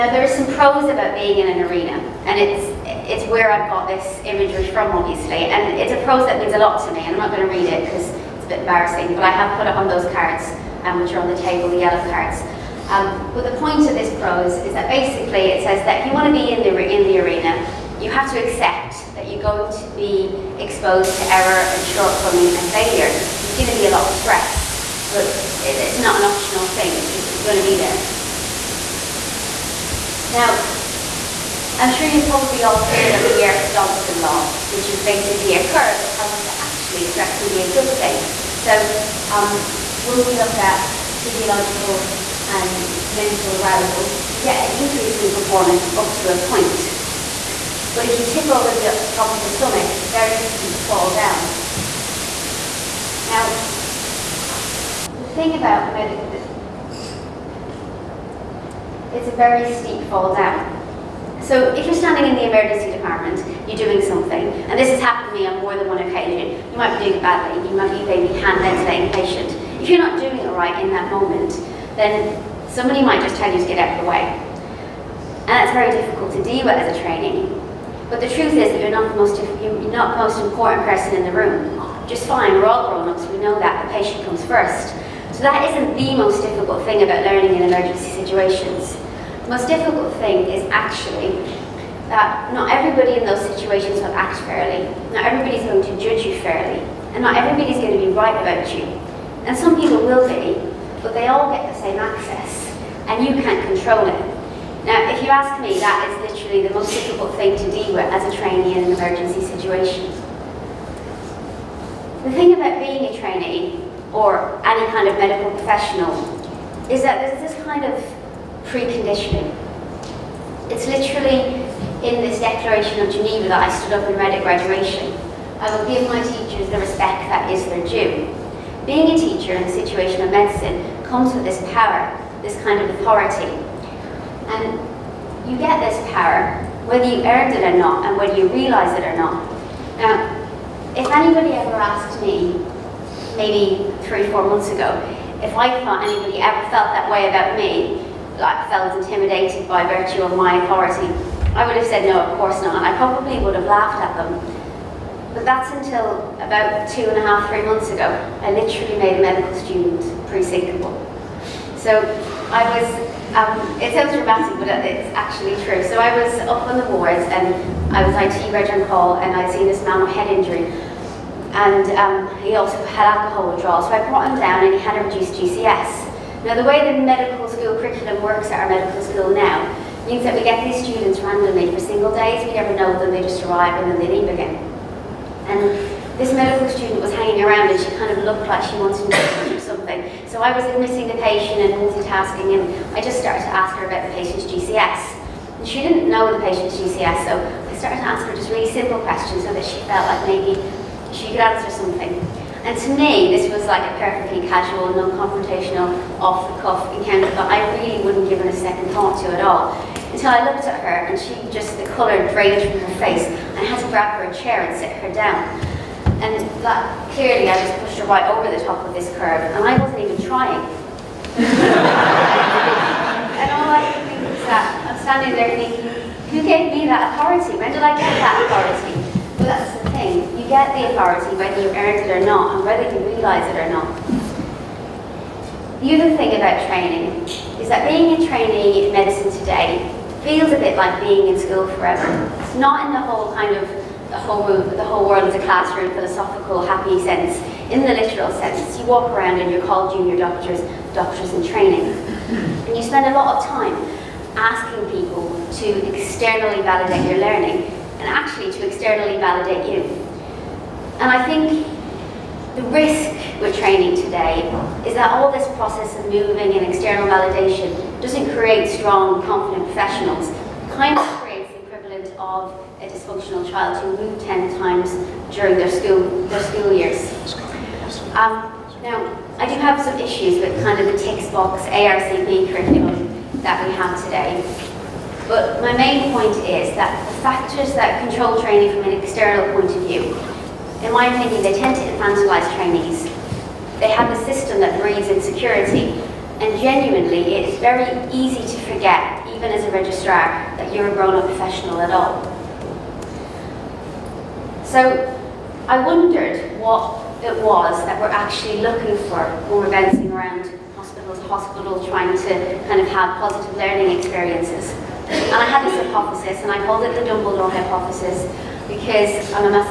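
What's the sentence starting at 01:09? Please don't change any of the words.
If you're not doing it right in that moment, then somebody might just tell you to get out of the way.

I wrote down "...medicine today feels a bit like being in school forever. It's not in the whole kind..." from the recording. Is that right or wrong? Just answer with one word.
right.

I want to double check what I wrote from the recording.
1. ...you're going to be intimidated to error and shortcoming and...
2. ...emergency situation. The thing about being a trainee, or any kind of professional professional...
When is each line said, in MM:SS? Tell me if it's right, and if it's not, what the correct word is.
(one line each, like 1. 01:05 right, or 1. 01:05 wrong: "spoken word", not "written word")
1. 00:19 wrong: "exposed", not "intimidated"
2. 01:48 wrong: "medical", not "professional".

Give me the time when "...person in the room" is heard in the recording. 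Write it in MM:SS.
01:20.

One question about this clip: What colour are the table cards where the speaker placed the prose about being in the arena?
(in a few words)
Yellow.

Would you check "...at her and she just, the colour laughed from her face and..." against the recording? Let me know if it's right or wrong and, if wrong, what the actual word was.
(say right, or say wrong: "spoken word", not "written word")
wrong: "drained", not "laughed".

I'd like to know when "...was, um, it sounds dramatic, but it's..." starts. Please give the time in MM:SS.
02:42.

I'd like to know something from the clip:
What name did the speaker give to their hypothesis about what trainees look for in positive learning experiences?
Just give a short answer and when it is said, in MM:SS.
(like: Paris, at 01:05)
Dumbledore hypothesis, at 05:17.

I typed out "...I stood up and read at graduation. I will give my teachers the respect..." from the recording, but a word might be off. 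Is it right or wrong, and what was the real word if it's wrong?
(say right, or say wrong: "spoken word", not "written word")
right.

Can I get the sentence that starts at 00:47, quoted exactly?
But if you tip over the top of the summit, it's a very steep fall down.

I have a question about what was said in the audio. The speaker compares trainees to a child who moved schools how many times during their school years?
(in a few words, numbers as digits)
10.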